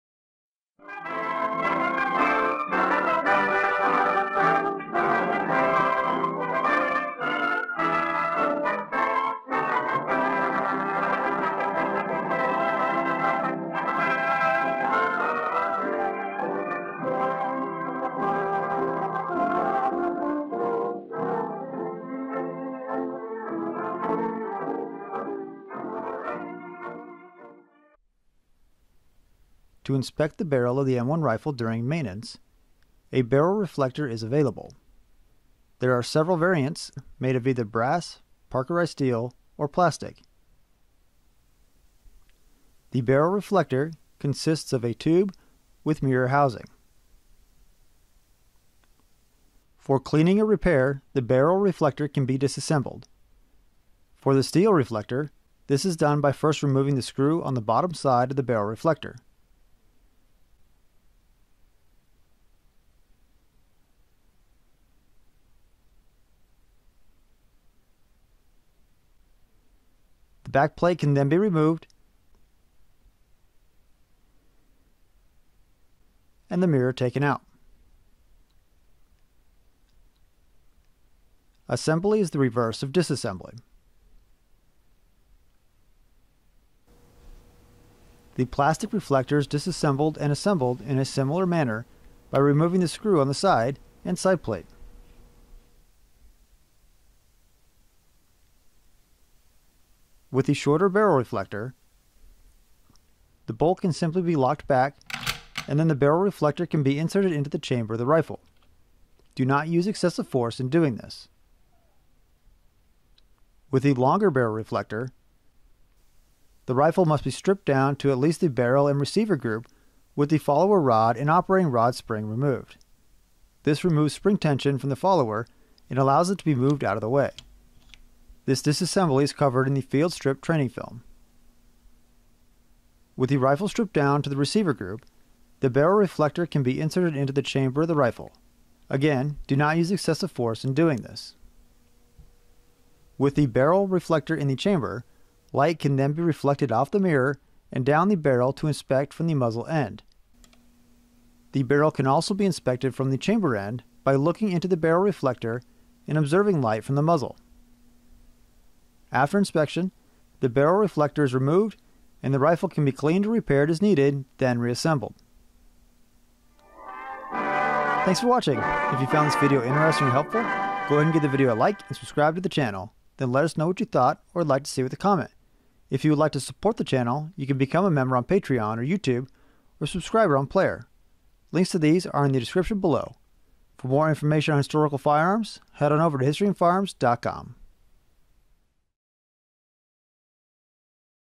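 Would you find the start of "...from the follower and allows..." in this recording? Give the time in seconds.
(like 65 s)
124 s.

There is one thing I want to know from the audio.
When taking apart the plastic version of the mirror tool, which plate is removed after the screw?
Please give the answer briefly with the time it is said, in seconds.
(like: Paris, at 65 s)
Side plate, at 94 s.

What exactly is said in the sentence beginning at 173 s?
Then let us know what you thought or would like to see with a comment.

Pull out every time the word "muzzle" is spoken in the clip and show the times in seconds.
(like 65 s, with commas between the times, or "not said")
149 s, 157 s.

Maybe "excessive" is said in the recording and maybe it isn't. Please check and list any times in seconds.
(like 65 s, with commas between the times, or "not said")
109 s, 139 s.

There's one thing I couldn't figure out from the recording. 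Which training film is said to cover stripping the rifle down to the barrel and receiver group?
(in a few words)
Field strip.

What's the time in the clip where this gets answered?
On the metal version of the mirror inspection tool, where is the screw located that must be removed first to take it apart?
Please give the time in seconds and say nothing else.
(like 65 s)
57 s.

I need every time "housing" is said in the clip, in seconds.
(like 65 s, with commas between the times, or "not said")
46 s.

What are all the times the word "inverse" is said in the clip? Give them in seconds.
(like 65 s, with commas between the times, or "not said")
not said.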